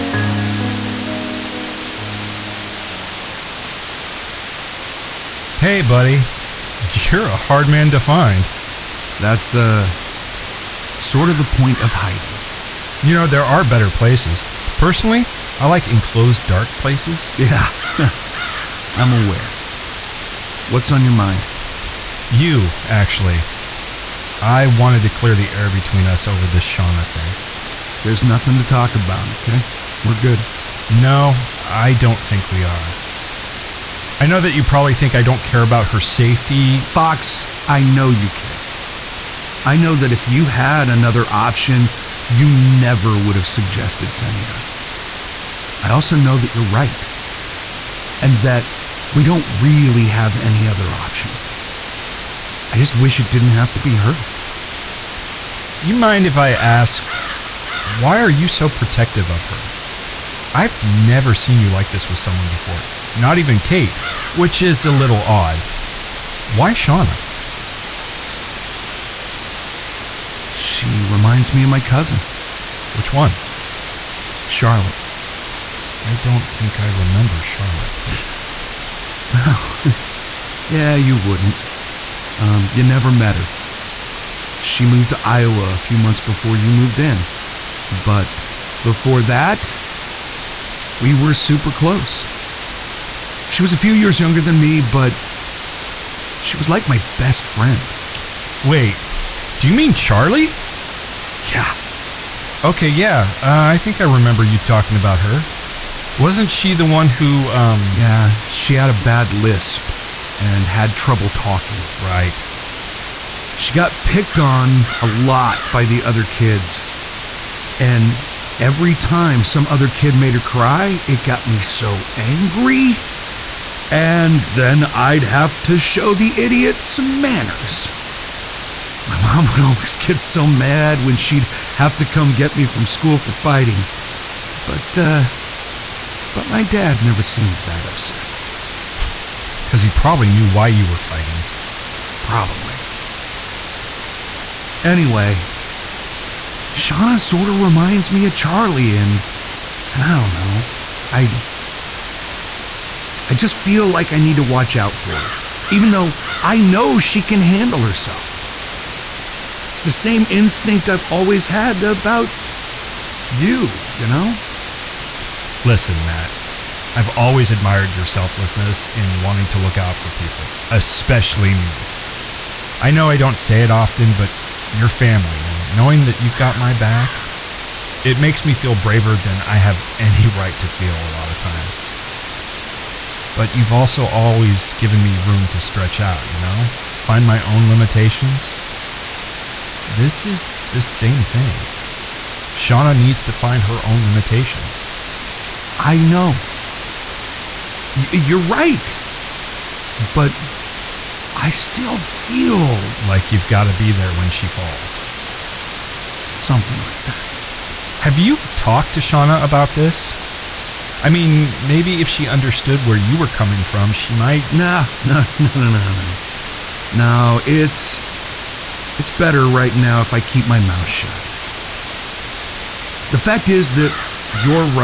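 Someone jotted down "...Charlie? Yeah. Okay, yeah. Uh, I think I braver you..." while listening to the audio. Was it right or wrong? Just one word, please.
wrong.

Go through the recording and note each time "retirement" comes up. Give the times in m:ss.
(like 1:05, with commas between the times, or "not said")
not said.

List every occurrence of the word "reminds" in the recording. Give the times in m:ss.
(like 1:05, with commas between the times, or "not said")
1:11, 2:27.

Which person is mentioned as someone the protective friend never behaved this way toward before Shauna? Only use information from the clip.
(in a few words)
Kate.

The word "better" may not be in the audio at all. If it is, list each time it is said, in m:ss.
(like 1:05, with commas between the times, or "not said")
0:13, 3:39.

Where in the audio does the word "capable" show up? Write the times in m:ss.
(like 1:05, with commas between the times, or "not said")
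not said.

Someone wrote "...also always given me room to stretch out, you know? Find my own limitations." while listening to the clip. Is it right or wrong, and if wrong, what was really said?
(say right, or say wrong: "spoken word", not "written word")
right.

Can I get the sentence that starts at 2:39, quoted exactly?
It's the same instinct I've always had about you, you know?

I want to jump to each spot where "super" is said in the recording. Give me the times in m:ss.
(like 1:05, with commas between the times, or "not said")
1:31.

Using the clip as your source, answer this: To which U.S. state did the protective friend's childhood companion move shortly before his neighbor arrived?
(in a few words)
Iowa.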